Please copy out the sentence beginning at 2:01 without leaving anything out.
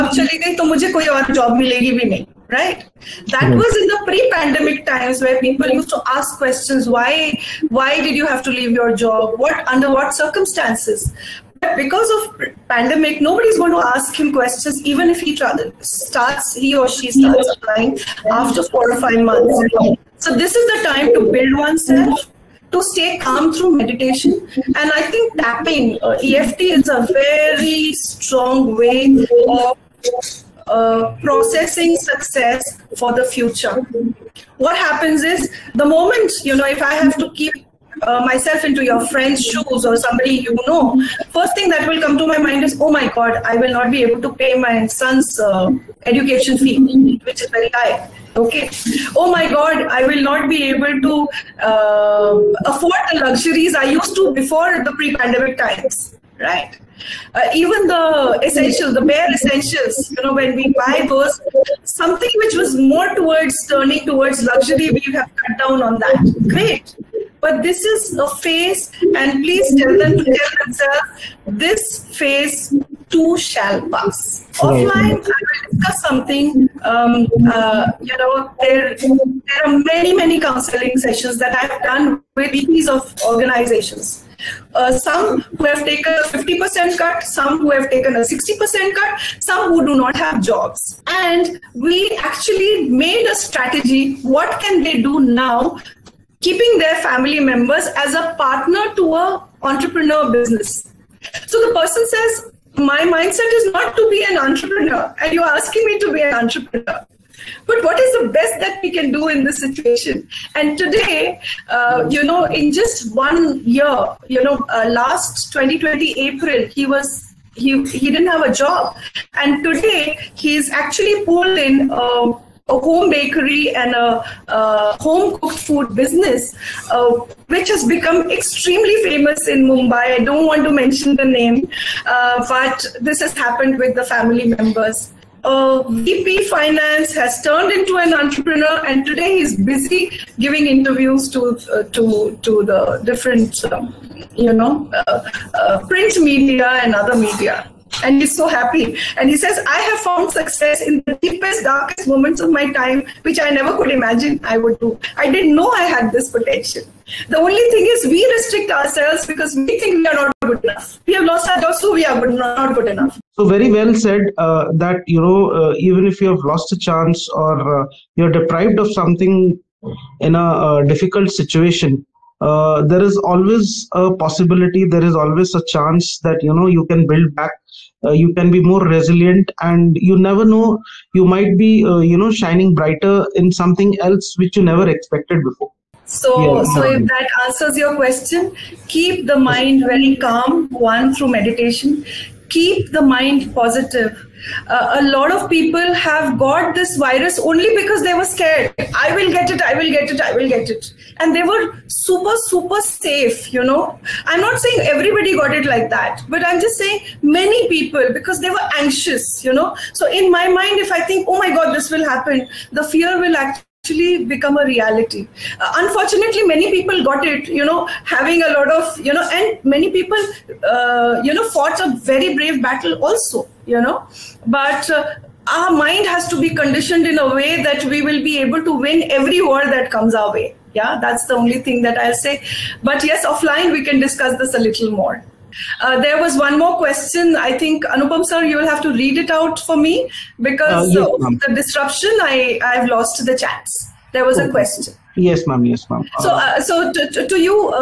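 Uh, a home bakery and a, a home cooked food business, uh, which has become extremely famous in Mumbai.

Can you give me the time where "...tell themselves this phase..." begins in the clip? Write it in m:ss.
1:10.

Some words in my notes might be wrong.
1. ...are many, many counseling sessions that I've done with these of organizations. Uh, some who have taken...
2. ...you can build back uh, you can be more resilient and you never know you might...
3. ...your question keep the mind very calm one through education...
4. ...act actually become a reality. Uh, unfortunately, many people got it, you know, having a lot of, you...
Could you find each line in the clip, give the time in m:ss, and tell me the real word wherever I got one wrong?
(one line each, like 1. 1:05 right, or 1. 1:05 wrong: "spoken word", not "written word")
1. 1:19 right
2. 2:56 right
3. 3:07 wrong: "meditation", not "education"
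4. 3:33 right.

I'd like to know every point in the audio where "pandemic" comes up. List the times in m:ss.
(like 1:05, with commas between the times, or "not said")
0:12, 0:54.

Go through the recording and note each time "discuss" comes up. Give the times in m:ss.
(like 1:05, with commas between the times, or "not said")
1:15, 3:53.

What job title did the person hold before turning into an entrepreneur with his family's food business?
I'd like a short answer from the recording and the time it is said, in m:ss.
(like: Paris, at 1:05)
VP Finance, at 2:15.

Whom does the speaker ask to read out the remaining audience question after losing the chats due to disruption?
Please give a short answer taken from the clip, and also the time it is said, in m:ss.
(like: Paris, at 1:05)
Anupam, at 3:57.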